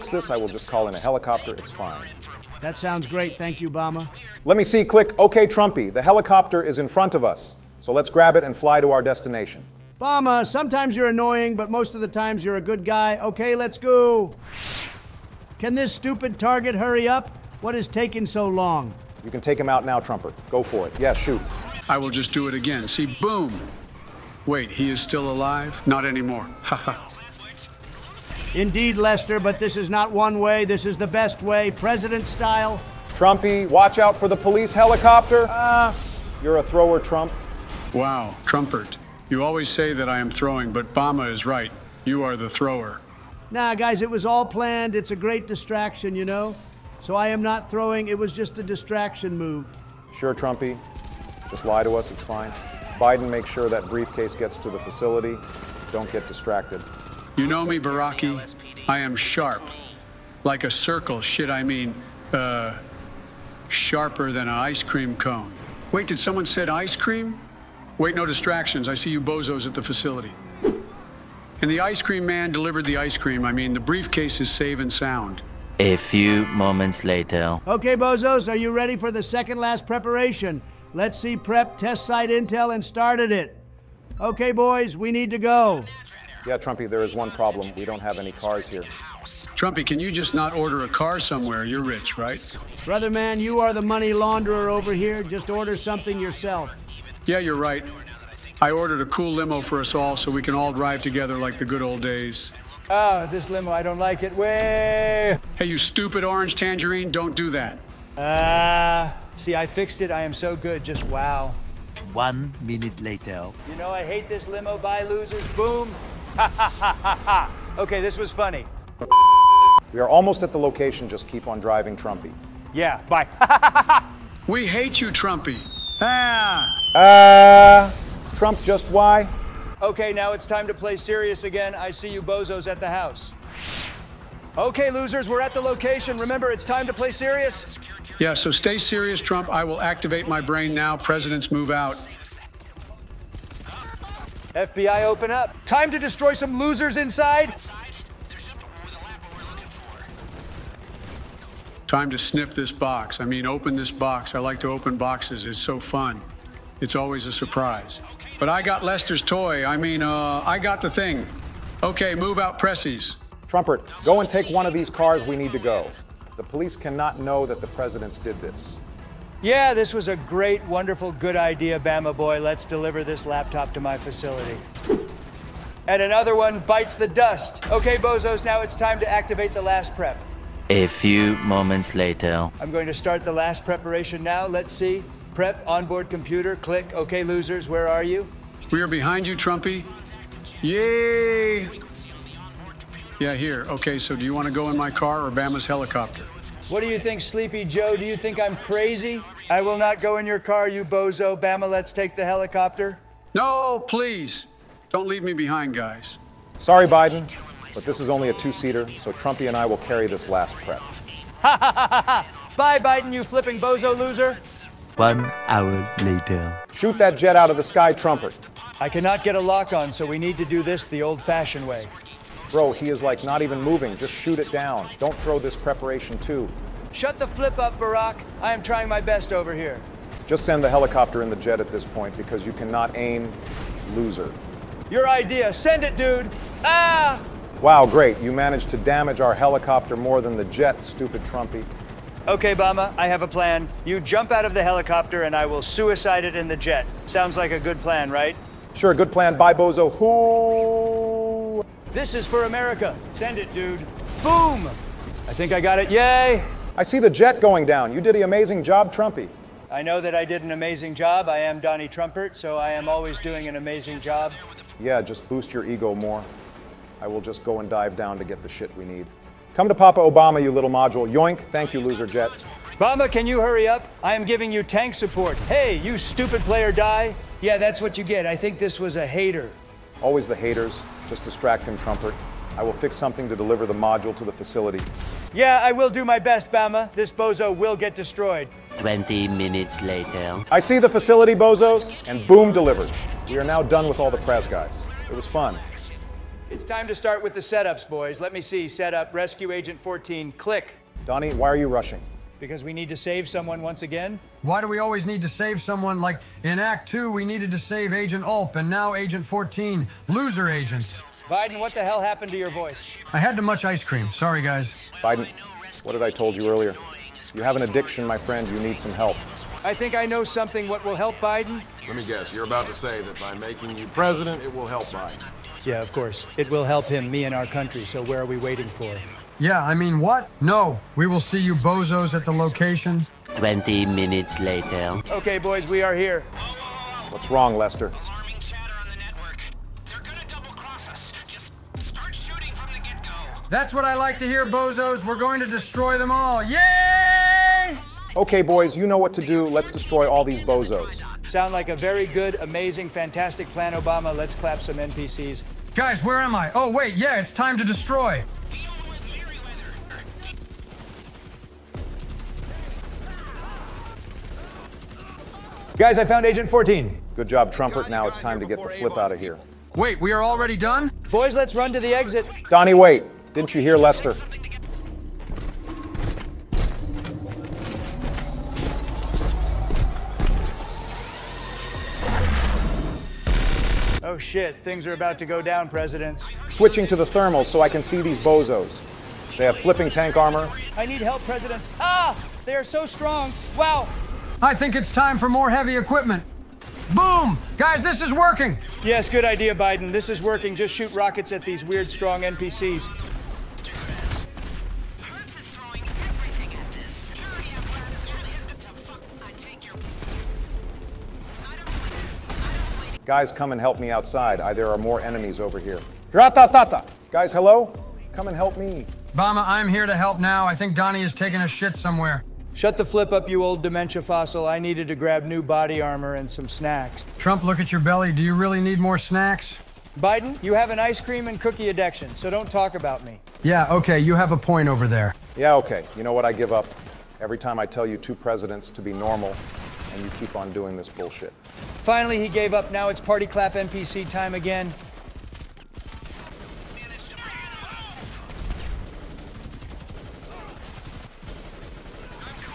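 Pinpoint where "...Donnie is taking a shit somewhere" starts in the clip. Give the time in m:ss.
7:00.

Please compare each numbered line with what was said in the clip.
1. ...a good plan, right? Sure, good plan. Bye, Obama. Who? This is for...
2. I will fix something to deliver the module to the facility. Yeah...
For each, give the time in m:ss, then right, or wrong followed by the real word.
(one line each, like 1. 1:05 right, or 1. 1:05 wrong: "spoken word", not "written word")
1. 4:07 wrong: "Bozo", not "Obama"
2. 4:42 right.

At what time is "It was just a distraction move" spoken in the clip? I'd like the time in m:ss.
0:48.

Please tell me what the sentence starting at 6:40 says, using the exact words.
Just shoot rockets at these weird, strong NPCs.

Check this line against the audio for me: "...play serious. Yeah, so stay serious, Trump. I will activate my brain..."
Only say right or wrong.
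right.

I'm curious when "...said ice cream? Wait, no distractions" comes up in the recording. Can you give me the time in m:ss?
1:06.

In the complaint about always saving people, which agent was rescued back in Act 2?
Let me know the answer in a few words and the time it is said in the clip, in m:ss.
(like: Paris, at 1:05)
Agent Ulp, at 5:07.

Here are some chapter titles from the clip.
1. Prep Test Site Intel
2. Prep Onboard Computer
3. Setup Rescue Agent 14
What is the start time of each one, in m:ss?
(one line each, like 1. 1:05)
1. 1:17
2. 3:02
3. 4:55.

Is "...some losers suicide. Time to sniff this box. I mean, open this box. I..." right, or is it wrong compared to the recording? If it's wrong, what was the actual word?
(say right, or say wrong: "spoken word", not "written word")
wrong: "inside", not "suicide".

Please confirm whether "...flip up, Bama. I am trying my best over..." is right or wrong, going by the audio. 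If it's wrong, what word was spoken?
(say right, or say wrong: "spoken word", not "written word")
wrong: "Barack", not "Bama".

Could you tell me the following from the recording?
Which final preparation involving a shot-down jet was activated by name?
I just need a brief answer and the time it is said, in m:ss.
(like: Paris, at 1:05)
Onboard computer, at 3:05.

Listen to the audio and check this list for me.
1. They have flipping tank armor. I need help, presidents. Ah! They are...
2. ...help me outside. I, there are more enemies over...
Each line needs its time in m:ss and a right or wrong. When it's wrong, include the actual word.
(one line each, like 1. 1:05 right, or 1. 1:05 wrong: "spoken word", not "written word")
1. 6:29 right
2. 6:53 right.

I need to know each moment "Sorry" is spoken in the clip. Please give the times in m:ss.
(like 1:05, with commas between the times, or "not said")
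3:26, 5:14.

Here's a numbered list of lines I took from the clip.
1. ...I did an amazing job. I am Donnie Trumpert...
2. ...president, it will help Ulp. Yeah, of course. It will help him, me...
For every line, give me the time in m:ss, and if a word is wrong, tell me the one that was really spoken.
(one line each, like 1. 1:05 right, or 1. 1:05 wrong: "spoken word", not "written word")
1. 4:20 right
2. 5:23 wrong: "Biden", not "Ulp".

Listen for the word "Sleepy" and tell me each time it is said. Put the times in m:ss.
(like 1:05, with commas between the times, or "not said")
3:17.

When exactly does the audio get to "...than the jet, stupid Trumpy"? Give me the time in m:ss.
4:00.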